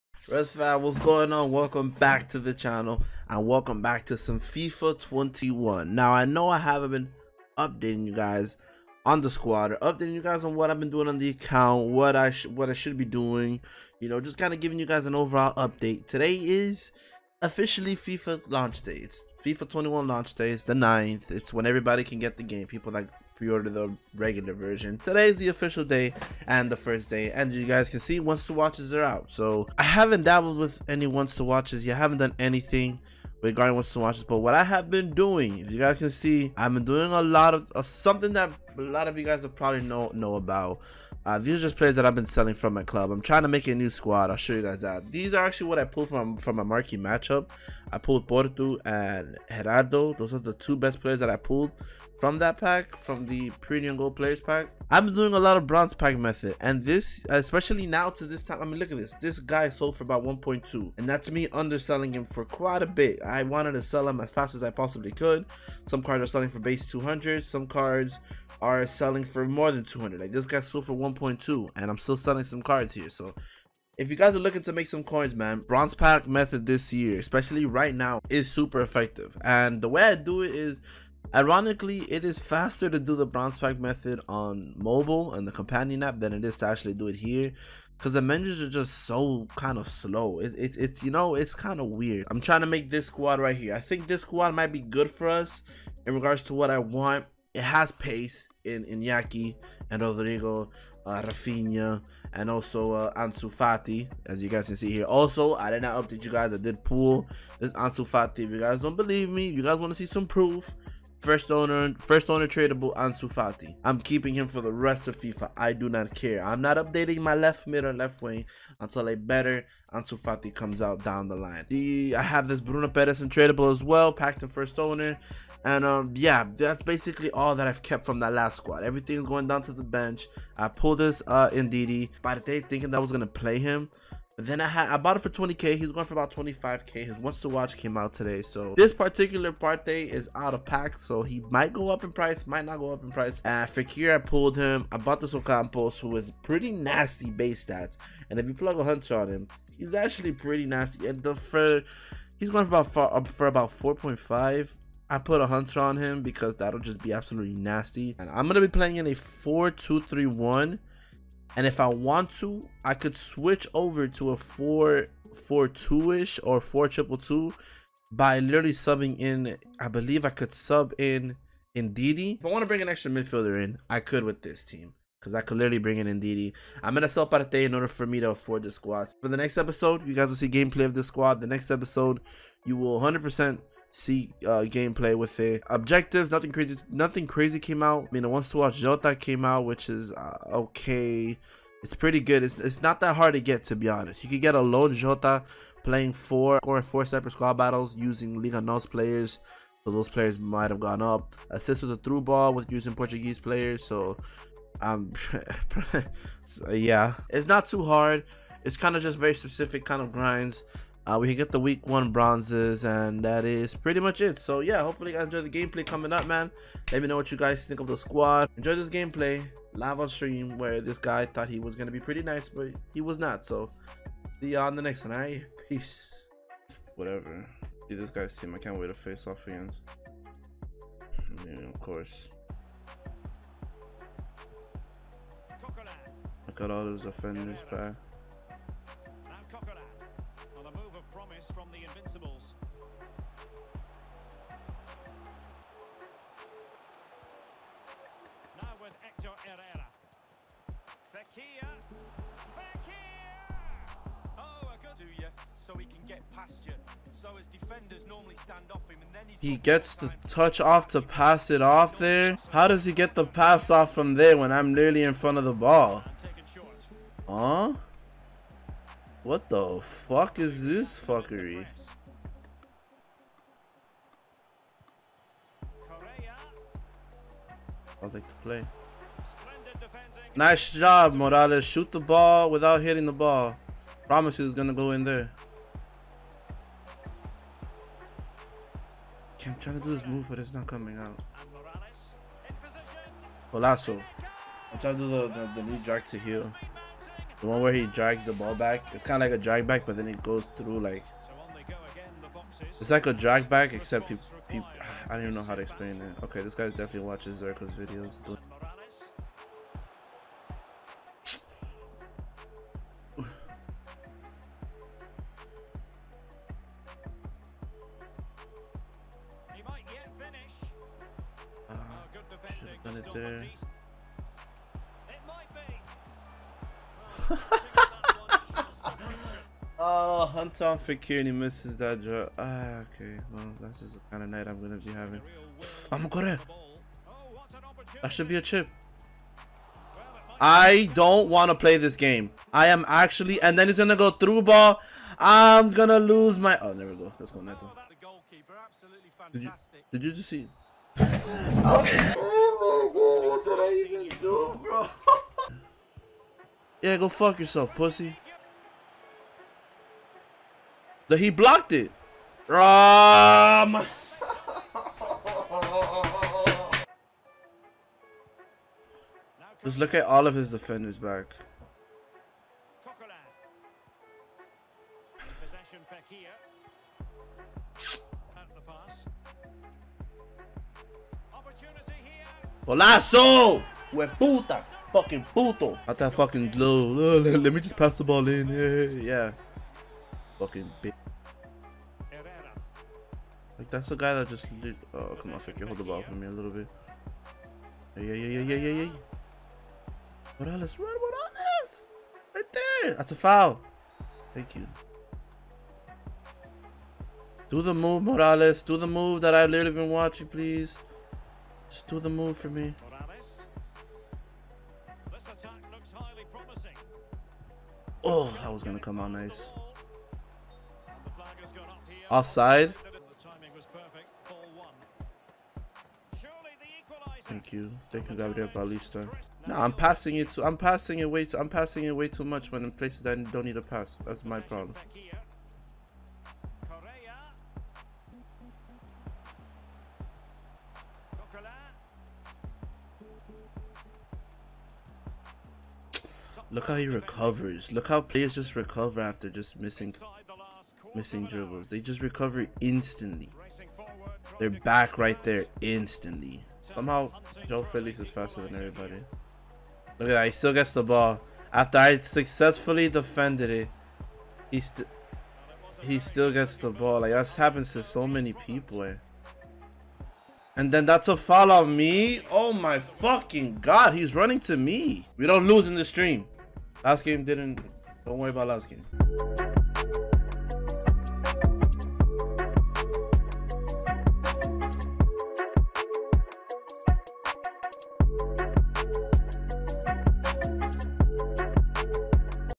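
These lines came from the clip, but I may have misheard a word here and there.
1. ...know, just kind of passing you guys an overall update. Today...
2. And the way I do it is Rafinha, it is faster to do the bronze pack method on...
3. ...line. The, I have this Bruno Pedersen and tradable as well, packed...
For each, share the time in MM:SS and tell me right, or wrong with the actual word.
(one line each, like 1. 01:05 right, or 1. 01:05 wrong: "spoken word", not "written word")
1. 00:14 wrong: "giving", not "passing"
2. 01:19 wrong: "Ironically", not "Rafinha"
3. 02:01 right.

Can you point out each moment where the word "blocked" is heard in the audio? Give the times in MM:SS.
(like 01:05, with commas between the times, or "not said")
06:01.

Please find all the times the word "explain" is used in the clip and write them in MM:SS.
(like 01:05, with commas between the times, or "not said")
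05:05.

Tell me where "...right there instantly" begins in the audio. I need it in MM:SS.
07:34.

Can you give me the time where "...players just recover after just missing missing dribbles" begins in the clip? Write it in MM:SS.
07:28.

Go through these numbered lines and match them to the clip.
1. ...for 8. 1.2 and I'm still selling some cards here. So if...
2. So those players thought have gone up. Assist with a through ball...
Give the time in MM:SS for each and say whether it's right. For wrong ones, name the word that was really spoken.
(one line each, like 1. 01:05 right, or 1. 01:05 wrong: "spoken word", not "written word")
1. 01:10 wrong: "1", not "8"
2. 03:19 wrong: "might", not "thought".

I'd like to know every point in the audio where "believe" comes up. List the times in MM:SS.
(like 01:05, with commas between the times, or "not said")
01:48, 02:49.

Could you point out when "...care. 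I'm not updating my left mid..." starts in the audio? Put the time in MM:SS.
01:56.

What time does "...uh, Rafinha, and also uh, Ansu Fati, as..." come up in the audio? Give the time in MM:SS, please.
01:41.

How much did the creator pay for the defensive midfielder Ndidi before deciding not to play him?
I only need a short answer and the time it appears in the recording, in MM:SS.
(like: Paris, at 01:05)
20k, at 02:15.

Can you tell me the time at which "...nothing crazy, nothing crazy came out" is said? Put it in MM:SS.
03:06.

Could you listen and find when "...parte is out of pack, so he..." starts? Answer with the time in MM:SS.
02:19.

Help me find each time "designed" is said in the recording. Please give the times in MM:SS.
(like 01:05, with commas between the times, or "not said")
not said.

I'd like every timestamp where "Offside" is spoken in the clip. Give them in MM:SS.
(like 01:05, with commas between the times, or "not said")
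07:02.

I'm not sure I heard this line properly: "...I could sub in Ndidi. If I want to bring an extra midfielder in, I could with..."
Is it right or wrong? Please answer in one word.
right.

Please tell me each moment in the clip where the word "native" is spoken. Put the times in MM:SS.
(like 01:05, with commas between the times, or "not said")
not said.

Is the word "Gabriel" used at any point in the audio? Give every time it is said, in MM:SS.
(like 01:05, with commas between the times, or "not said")
07:08.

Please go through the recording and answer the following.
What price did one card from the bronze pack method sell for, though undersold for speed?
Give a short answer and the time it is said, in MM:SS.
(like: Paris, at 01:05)
1.2, at 01:00.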